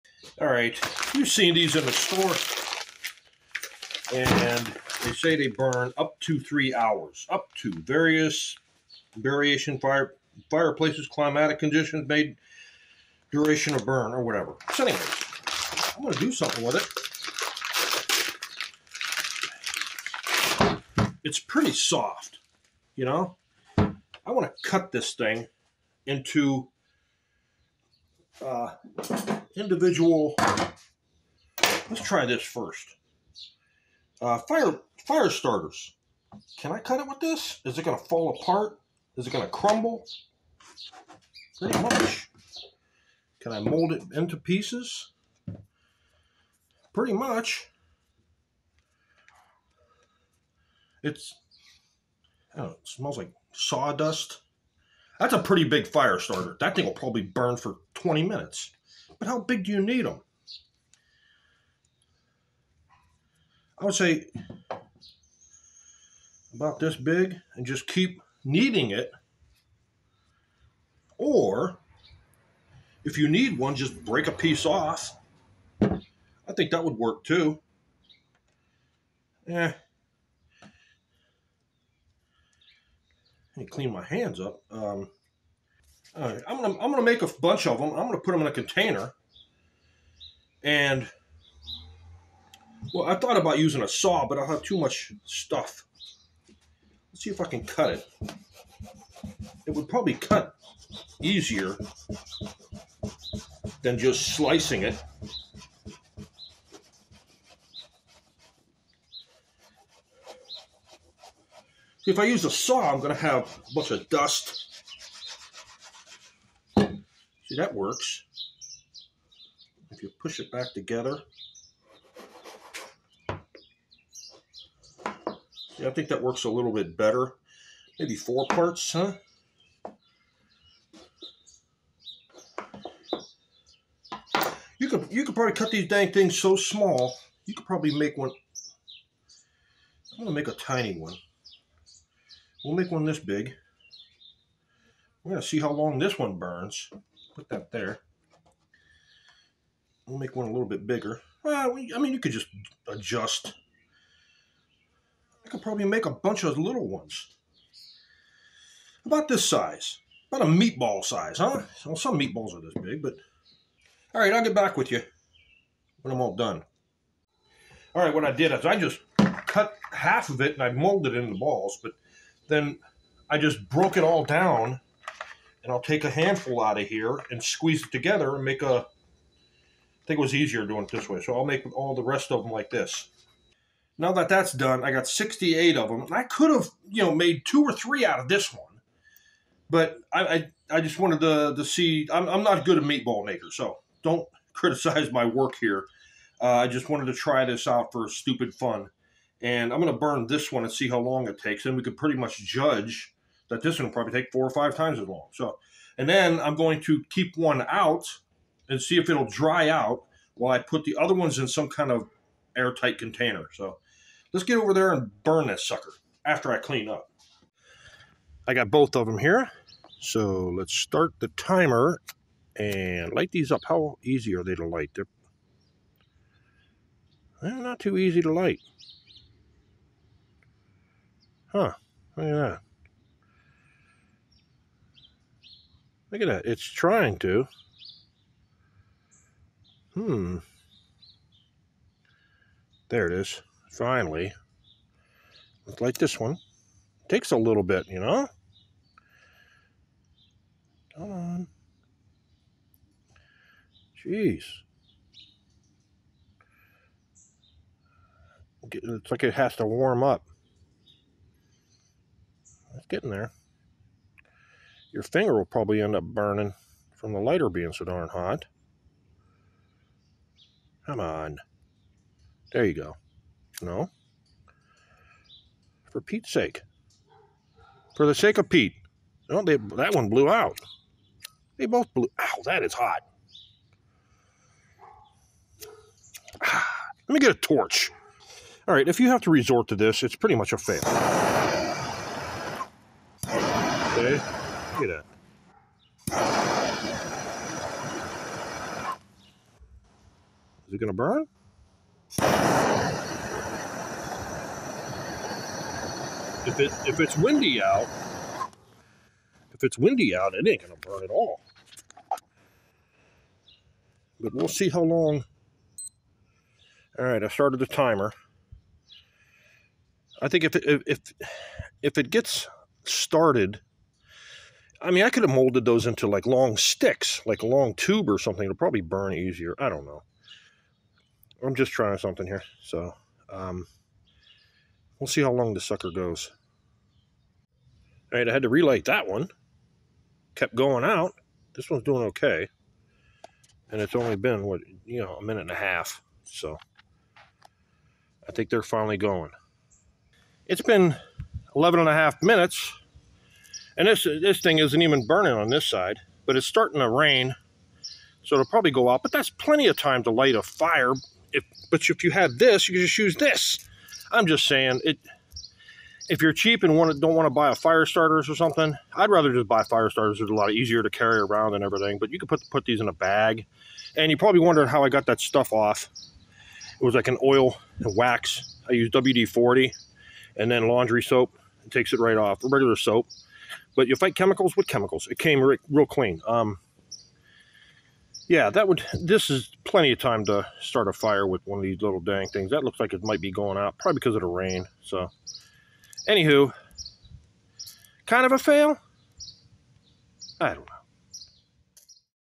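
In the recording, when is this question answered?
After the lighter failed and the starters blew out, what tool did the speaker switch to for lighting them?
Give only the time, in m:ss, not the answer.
4:47.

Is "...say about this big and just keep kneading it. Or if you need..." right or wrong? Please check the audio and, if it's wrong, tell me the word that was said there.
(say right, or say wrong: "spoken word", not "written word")
right.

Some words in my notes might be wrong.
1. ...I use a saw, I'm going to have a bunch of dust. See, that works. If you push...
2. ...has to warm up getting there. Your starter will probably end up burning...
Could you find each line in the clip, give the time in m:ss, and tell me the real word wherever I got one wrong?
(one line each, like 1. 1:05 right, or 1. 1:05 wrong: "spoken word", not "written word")
1. 1:52 right
2. 4:19 wrong: "finger", not "starter".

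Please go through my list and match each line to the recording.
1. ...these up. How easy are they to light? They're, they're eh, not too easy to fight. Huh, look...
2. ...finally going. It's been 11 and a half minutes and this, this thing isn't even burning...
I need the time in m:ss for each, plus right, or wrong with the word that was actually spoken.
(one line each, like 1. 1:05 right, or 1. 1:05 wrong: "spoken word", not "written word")
1. 3:43 wrong: "light", not "fight"
2. 5:48 right.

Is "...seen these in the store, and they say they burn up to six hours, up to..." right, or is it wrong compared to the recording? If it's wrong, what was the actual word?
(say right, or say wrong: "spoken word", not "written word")
wrong: "three", not "six".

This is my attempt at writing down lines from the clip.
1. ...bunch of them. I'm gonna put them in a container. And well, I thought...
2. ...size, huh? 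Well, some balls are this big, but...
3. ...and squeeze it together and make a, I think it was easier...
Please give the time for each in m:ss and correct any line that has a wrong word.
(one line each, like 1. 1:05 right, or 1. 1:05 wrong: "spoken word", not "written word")
1. 1:27 right
2. 2:41 wrong: "meatballs", not "balls"
3. 2:57 right.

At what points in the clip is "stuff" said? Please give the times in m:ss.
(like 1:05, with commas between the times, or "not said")
1:35, 6:15.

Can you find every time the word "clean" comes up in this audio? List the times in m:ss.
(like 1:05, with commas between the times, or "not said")
1:23, 3:36, 6:25.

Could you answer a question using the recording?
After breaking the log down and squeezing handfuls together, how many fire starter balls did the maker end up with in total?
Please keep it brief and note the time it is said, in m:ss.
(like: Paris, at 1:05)
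68, at 3:05.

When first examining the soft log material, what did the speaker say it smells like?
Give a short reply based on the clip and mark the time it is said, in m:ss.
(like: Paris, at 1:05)
Sawdust, at 0:53.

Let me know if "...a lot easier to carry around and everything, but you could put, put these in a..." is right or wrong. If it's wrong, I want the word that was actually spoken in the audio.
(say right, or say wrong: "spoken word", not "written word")
right.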